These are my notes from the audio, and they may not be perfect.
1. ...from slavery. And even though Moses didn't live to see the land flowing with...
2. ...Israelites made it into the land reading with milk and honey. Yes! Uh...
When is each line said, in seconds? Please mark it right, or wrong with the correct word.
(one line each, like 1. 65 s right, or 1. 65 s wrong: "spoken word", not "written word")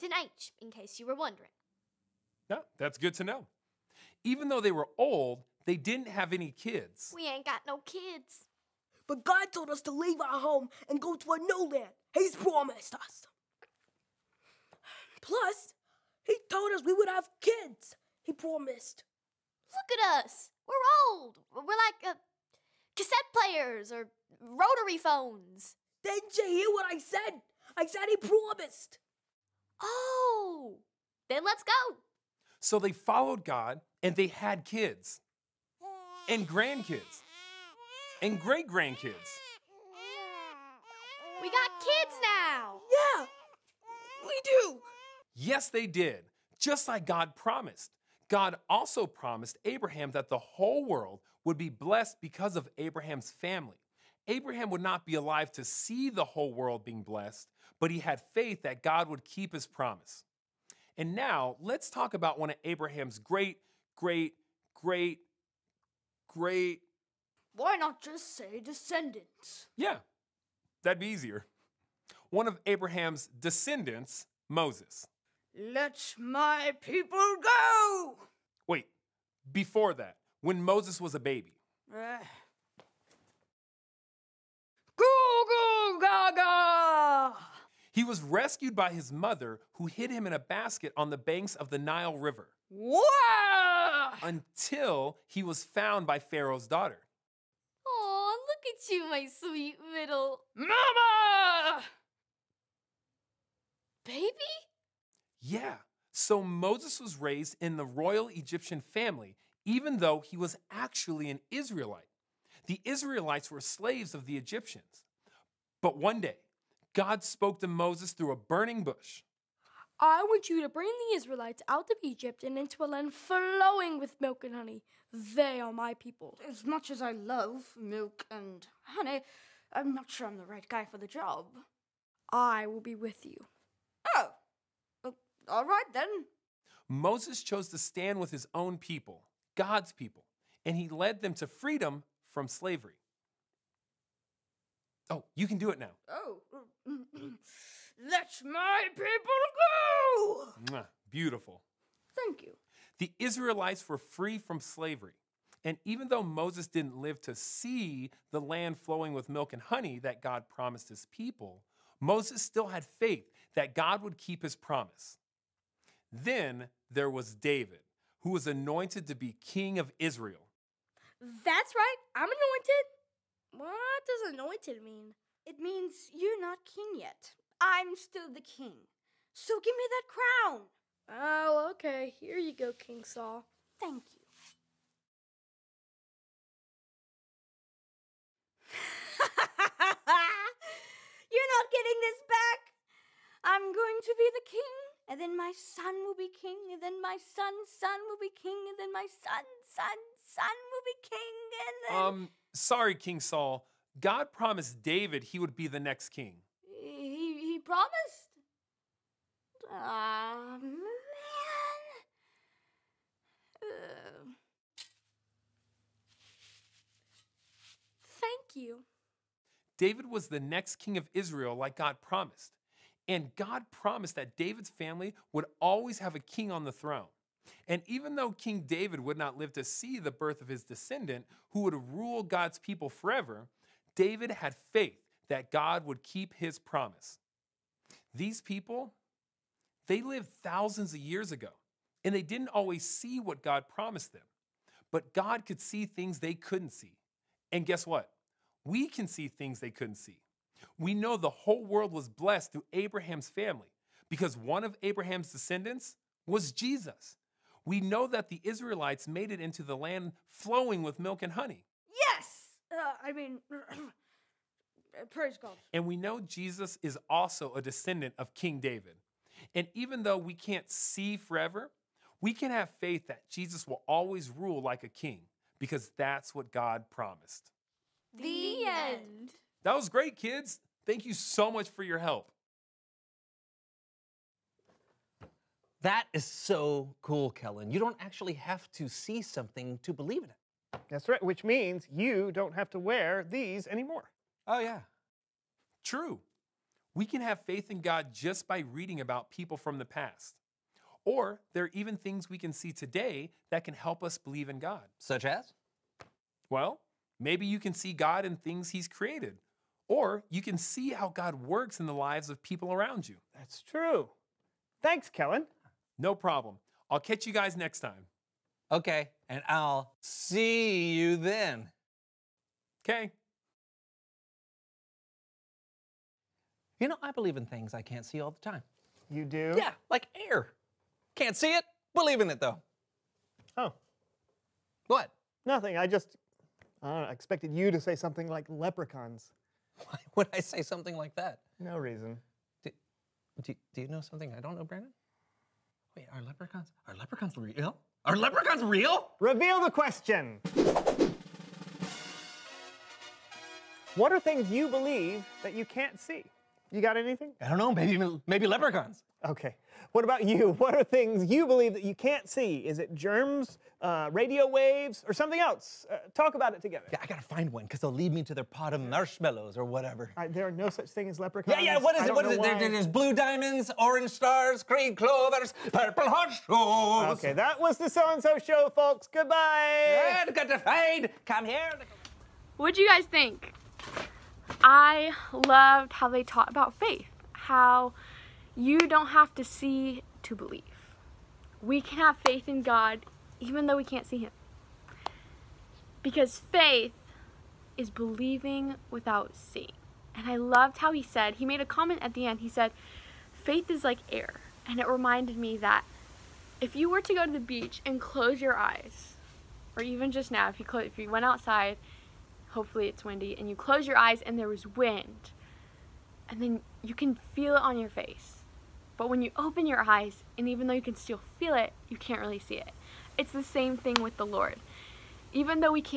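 1. 154 s right
2. 258 s wrong: "flowing", not "reading".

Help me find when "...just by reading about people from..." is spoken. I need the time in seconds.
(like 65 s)
298 s.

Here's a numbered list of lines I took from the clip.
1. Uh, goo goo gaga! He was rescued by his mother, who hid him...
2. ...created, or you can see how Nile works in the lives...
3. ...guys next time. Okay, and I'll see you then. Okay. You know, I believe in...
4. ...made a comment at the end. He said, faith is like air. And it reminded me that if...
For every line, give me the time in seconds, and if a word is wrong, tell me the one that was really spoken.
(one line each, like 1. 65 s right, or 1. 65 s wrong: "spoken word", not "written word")
1. 81 s right
2. 308 s wrong: "God", not "Nile"
3. 317 s right
4. 401 s right.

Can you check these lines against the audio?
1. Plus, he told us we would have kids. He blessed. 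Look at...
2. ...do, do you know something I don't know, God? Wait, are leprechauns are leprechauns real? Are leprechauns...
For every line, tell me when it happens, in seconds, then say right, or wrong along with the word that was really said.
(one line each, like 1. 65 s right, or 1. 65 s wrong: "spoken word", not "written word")
1. 15 s wrong: "promised", not "blessed"
2. 343 s wrong: "Brandon", not "God".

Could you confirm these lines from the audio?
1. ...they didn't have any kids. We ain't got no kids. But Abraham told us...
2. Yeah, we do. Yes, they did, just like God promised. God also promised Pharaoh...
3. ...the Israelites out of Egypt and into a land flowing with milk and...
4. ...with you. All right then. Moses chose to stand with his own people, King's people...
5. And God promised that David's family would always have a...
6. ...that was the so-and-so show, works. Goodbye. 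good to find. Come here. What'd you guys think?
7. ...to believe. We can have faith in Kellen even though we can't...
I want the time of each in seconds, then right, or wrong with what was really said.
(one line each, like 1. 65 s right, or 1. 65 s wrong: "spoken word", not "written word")
1. 5 s wrong: "God", not "Abraham"
2. 42 s wrong: "Abraham", not "Pharaoh"
3. 121 s right
4. 132 s wrong: "God", not "King"
5. 223 s right
6. 377 s wrong: "folks", not "works"
7. 390 s wrong: "God", not "Kellen".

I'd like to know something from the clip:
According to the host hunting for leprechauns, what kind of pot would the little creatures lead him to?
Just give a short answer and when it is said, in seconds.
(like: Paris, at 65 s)
Pot of marshmallows, at 368 s.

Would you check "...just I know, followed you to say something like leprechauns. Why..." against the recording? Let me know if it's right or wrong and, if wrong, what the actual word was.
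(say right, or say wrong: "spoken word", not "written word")
wrong: "expected", not "followed".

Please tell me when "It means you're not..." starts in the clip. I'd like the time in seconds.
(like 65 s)
175 s.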